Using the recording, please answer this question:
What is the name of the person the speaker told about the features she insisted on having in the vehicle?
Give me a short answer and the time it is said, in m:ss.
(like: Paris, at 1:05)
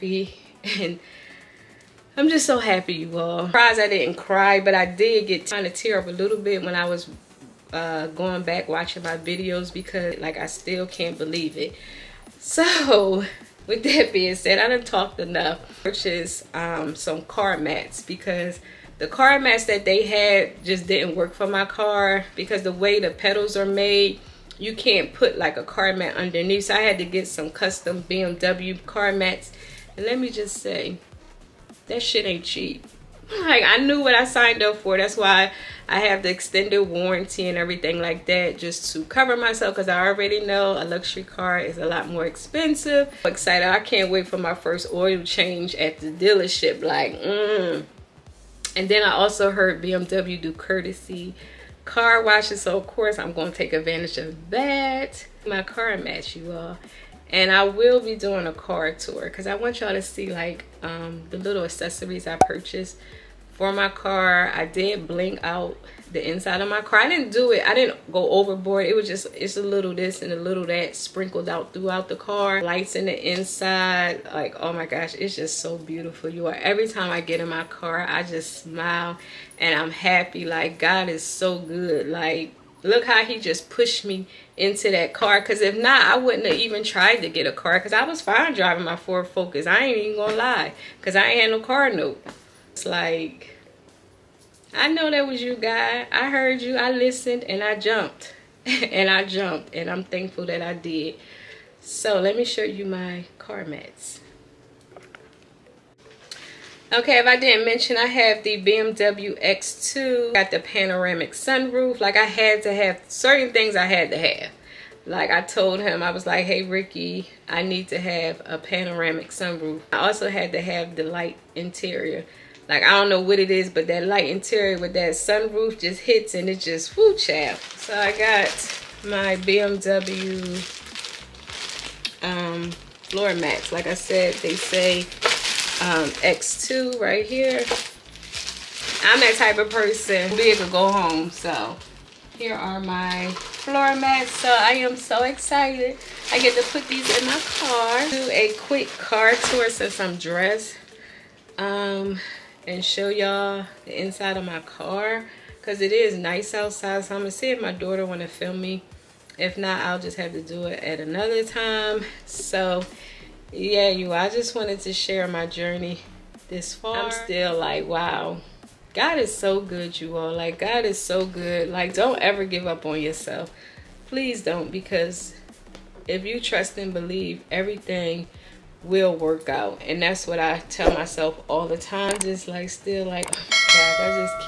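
Ricky, at 1:56.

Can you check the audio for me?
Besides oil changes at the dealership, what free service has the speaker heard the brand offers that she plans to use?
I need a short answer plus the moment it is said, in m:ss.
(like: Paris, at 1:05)
Courtesy car washes, at 0:50.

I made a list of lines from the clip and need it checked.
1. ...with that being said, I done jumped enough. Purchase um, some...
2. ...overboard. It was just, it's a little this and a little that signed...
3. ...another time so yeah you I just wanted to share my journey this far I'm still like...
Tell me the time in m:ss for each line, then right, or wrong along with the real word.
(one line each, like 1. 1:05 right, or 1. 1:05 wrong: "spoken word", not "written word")
1. 0:13 wrong: "talked", not "jumped"
2. 1:08 wrong: "sprinkled", not "signed"
3. 2:40 right.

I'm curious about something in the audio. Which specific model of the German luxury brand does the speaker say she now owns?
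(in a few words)
BMW X2.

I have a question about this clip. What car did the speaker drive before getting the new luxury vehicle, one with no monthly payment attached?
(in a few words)
Ford Focus.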